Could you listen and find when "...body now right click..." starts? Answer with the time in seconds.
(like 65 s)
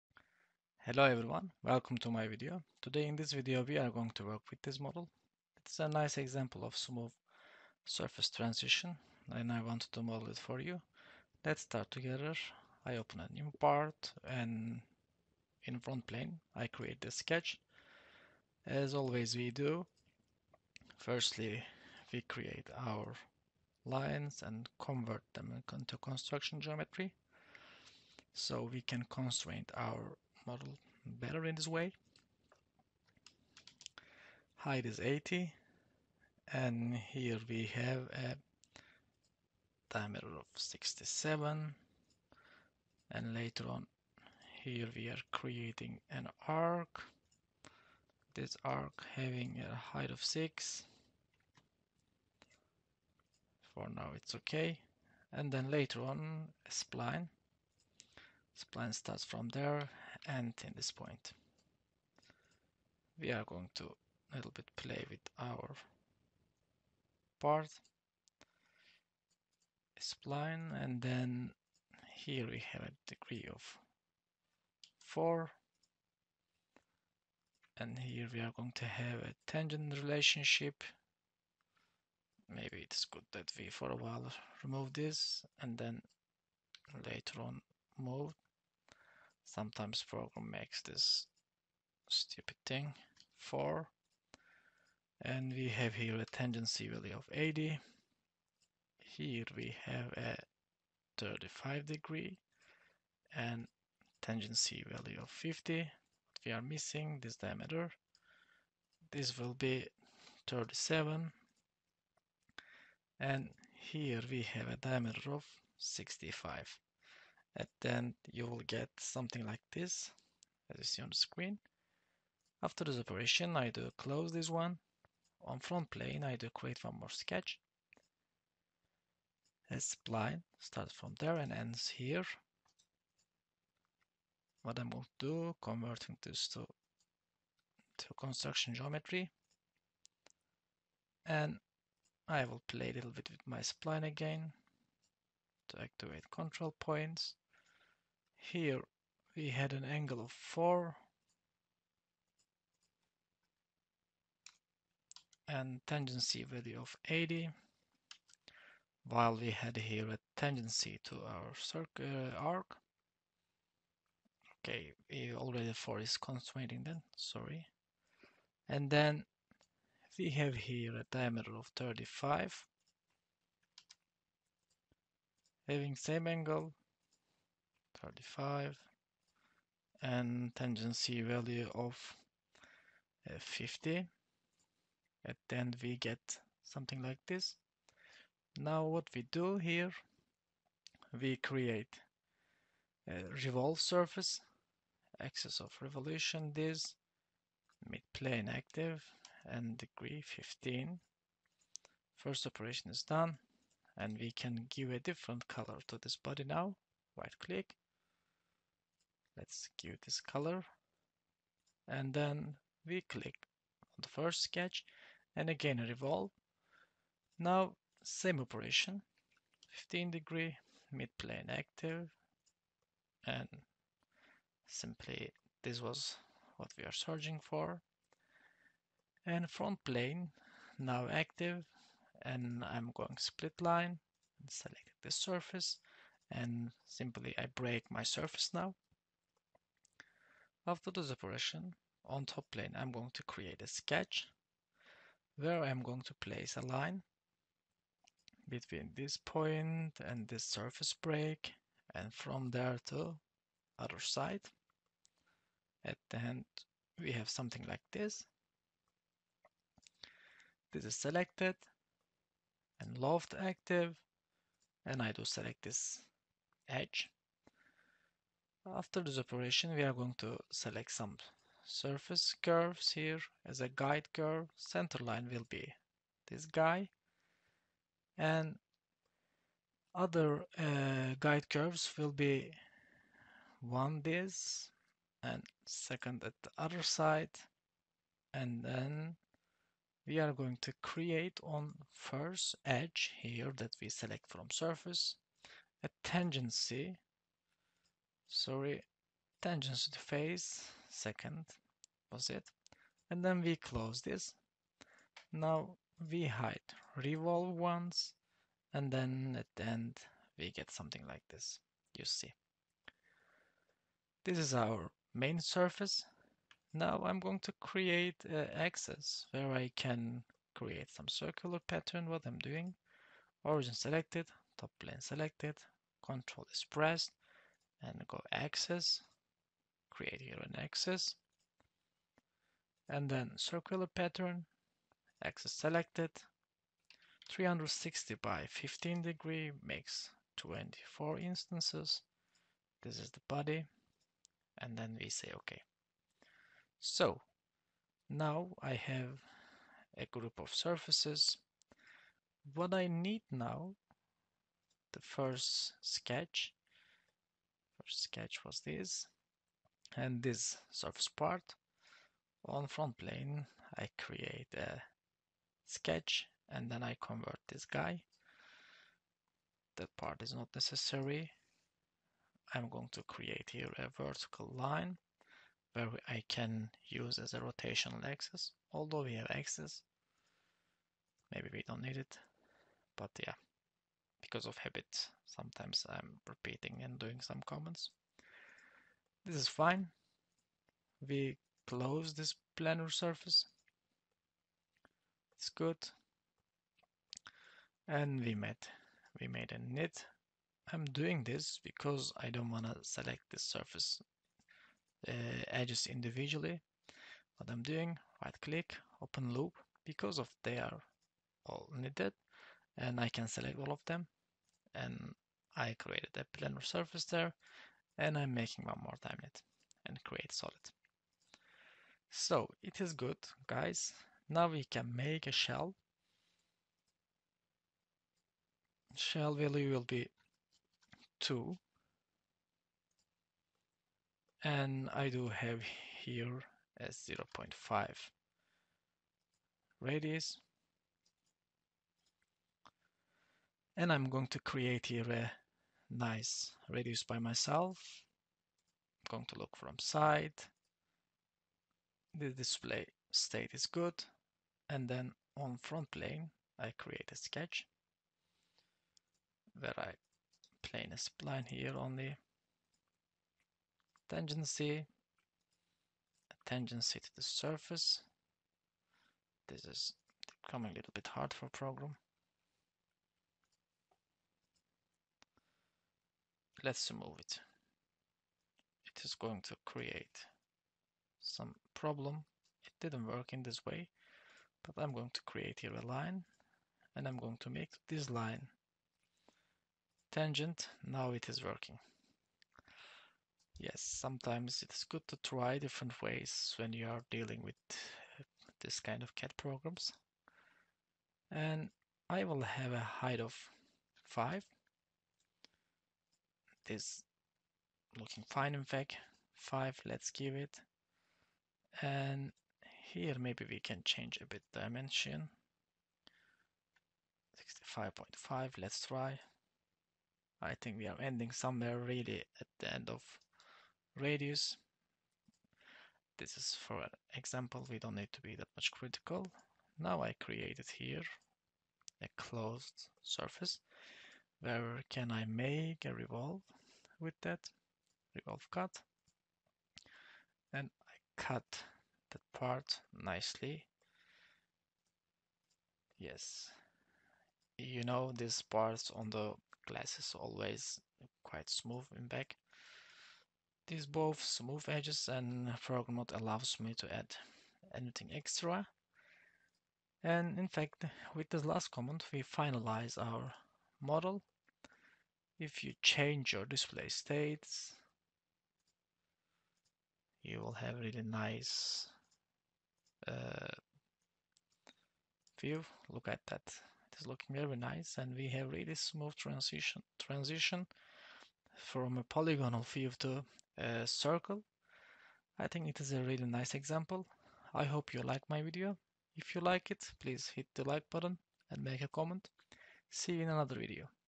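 206 s.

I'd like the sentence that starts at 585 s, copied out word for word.
I think it is a really nice example.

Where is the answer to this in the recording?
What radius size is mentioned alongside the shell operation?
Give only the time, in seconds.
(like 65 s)
437 s.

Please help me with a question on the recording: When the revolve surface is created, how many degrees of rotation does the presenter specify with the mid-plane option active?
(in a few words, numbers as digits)
15.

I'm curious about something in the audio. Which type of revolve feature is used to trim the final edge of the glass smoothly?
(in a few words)
revolve cut.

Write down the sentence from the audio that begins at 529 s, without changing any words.
Now I created here a closed surface.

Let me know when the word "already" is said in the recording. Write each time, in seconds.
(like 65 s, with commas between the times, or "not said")
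165 s.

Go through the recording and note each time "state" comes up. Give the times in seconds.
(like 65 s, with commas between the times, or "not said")
453 s, 566 s.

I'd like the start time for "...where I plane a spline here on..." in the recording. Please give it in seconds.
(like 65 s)
459 s.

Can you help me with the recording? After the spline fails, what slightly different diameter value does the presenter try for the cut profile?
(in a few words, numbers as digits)
65.5.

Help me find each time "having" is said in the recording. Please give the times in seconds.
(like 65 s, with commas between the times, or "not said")
49 s, 175 s.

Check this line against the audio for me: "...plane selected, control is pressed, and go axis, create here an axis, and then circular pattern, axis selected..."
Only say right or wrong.
right.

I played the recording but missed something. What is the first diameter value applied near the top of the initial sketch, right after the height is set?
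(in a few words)
67.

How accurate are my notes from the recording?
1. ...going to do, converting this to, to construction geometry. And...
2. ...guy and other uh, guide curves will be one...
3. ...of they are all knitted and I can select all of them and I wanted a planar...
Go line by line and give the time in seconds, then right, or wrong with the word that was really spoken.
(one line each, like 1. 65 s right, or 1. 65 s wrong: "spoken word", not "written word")
1. 134 s right
2. 276 s right
3. 410 s wrong: "created", not "wanted".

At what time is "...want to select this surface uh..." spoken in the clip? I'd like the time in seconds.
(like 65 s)
402 s.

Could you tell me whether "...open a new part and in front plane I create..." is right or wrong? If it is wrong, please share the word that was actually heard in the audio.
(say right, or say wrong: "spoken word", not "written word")
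right.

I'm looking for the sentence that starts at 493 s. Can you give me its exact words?
Yes, sometimes it's good to try different ways when you are dealing with uh, this kind of CAD programs.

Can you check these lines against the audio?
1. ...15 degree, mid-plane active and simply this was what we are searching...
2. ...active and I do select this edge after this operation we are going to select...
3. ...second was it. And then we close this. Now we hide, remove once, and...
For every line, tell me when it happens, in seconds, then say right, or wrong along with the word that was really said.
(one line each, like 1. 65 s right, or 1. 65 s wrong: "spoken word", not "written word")
1. 219 s right
2. 263 s right
3. 300 s wrong: "revolve", not "remove".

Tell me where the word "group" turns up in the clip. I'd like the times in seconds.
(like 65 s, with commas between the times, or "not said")
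350 s.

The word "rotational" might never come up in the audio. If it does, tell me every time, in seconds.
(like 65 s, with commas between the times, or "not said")
377 s.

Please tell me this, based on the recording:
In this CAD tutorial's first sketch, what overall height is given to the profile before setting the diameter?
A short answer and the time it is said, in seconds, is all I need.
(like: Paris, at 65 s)
80, at 34 s.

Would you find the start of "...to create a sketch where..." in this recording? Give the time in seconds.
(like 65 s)
243 s.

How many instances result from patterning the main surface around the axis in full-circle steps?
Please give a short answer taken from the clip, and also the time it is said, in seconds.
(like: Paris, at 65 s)
24, at 340 s.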